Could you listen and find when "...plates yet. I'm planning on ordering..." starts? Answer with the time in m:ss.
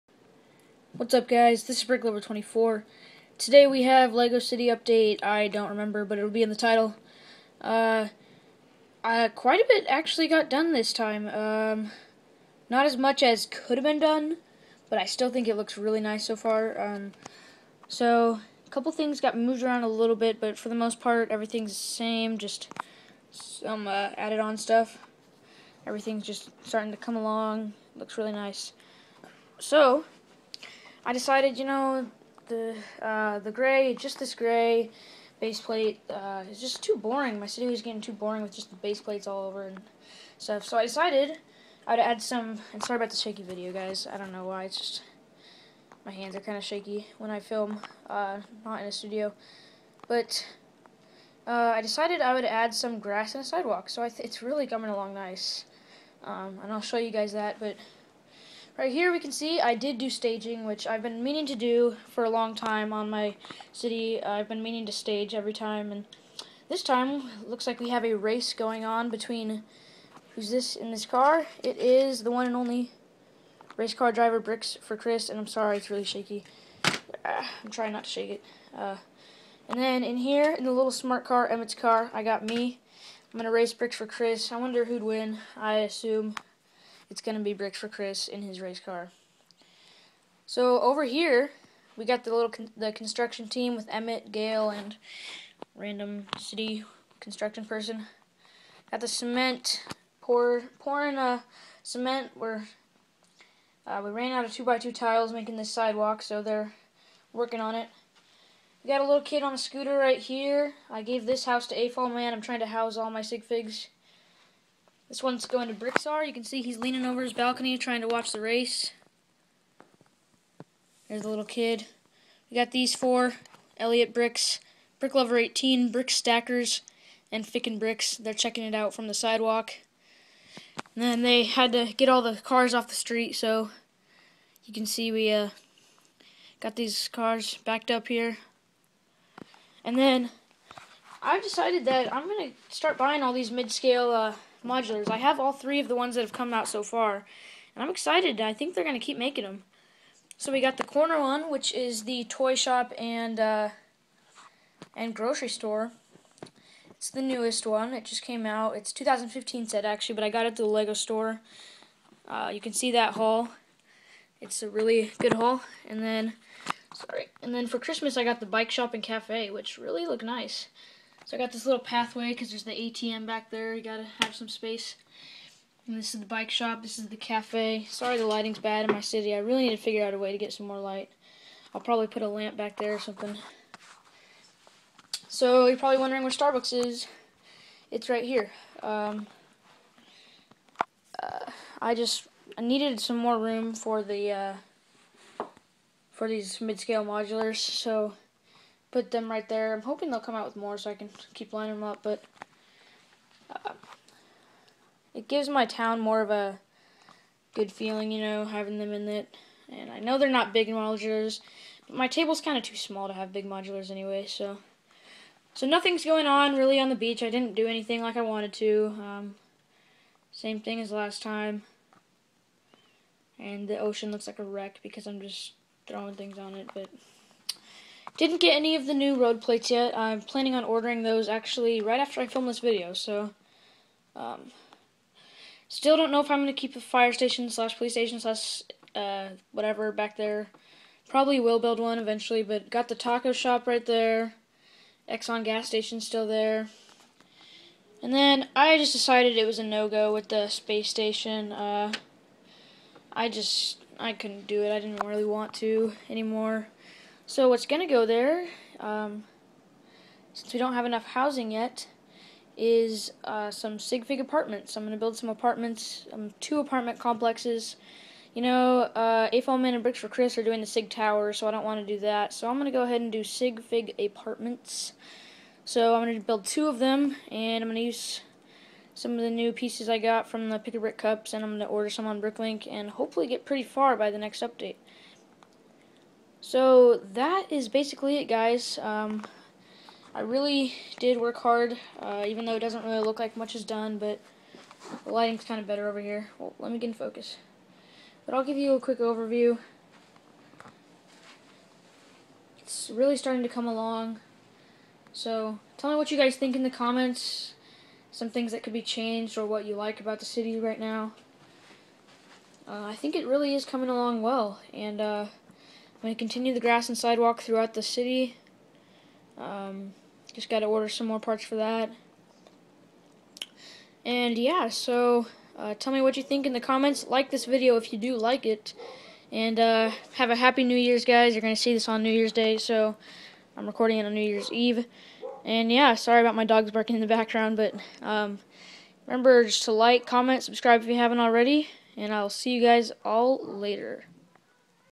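3:49.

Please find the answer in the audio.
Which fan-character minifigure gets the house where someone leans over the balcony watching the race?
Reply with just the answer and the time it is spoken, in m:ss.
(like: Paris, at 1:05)
Brixar, at 1:55.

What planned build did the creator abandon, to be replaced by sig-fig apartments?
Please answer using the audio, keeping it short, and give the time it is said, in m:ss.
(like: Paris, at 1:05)
space station, at 4:10.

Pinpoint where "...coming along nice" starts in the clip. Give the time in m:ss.
0:54.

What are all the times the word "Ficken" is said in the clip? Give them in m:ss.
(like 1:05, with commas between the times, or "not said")
2:07.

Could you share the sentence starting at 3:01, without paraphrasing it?
I'll probably put a lamp back there or something.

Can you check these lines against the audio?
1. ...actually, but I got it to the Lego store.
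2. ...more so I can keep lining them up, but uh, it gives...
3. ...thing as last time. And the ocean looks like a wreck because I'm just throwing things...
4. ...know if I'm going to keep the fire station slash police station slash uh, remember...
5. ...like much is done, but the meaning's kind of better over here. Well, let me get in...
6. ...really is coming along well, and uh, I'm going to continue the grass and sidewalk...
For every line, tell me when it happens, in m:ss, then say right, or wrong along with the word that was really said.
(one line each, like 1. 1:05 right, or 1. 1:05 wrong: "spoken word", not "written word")
1. 2:39 right
2. 3:20 right
3. 3:40 right
4. 3:56 wrong: "whatever", not "remember"
5. 4:53 wrong: "lighting", not "meaning"
6. 5:13 right.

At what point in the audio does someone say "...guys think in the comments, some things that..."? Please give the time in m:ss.
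5:06.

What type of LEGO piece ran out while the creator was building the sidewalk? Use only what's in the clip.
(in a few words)
two by two tiles.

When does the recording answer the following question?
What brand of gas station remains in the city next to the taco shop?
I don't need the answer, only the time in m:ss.
4:05.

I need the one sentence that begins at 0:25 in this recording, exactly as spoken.
Everything's just starting to come along, looks really nice.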